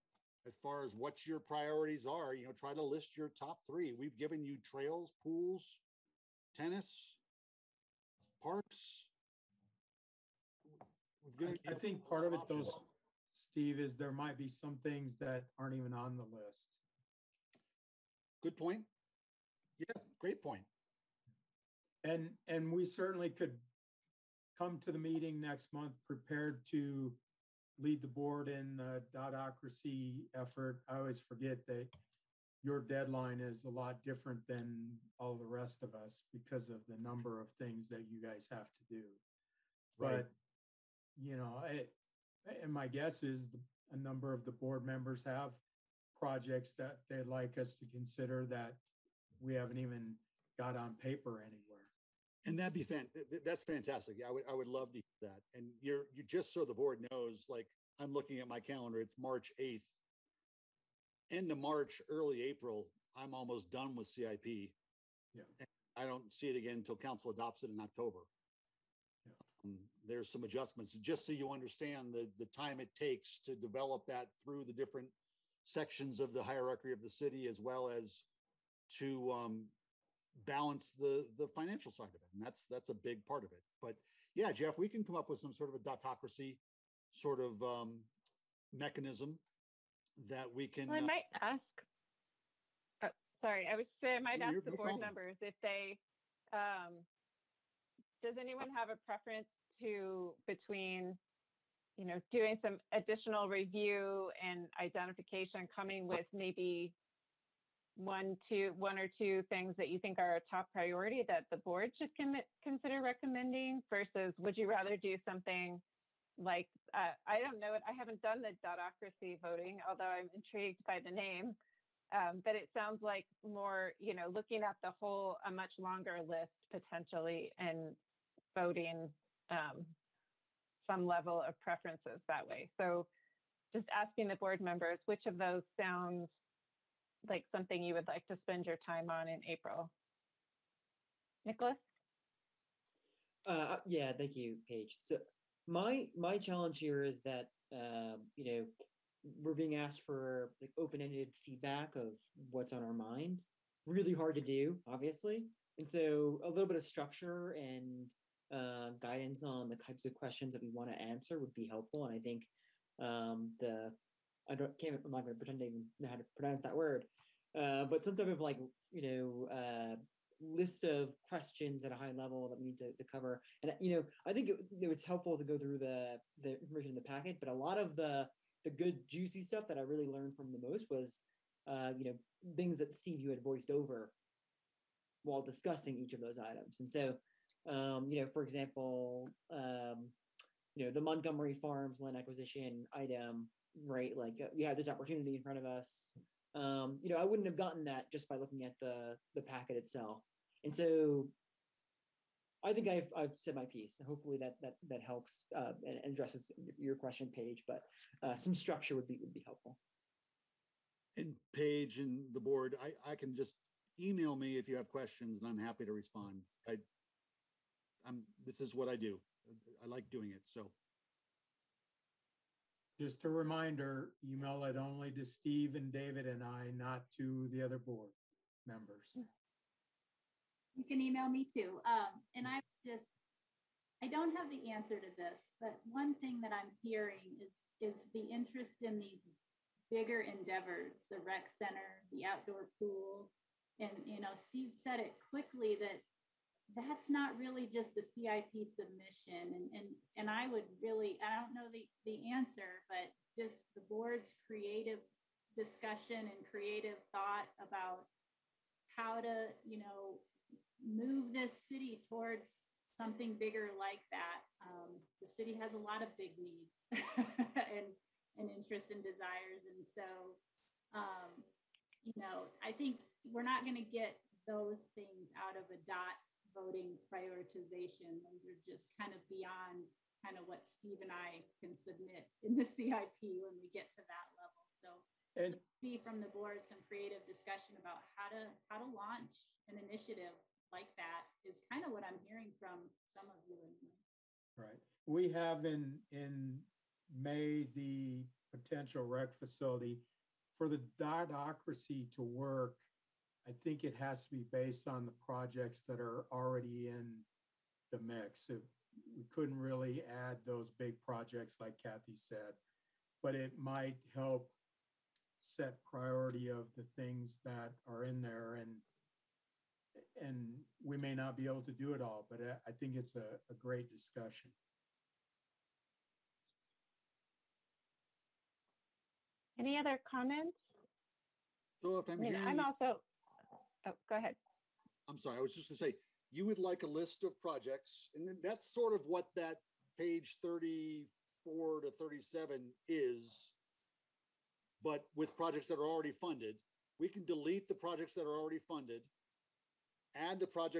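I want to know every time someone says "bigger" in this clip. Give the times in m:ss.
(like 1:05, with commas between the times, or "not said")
3:59, 4:23.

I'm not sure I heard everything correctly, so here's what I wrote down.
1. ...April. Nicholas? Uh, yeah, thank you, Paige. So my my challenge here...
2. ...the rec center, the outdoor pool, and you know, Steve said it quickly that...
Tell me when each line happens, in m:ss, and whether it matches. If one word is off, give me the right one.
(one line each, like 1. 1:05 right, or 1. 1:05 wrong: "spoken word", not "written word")
1. 2:19 right
2. 4:01 right.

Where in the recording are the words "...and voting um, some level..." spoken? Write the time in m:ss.
2:07.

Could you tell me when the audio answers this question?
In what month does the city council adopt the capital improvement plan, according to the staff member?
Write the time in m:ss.
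1:07.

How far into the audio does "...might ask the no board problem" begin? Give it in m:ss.
1:34.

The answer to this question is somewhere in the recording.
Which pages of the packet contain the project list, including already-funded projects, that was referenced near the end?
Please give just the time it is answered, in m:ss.
5:39.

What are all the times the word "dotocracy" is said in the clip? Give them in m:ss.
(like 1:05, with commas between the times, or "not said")
0:29, 1:25, 1:58, 5:00.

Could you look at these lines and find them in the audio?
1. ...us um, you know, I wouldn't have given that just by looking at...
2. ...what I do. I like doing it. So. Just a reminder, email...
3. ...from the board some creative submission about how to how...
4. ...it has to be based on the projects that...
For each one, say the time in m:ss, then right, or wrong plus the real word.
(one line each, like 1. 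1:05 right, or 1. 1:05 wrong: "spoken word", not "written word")
1. 3:15 wrong: "gotten", not "given"
2. 3:38 right
3. 4:45 wrong: "discussion", not "submission"
4. 5:03 right.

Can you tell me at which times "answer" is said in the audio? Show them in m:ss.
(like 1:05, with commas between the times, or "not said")
2:40, 3:54, 4:12.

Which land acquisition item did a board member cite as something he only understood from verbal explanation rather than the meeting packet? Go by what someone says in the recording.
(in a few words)
Montgomery Farms.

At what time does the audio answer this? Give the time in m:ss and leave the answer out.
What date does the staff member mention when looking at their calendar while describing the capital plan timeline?
0:59.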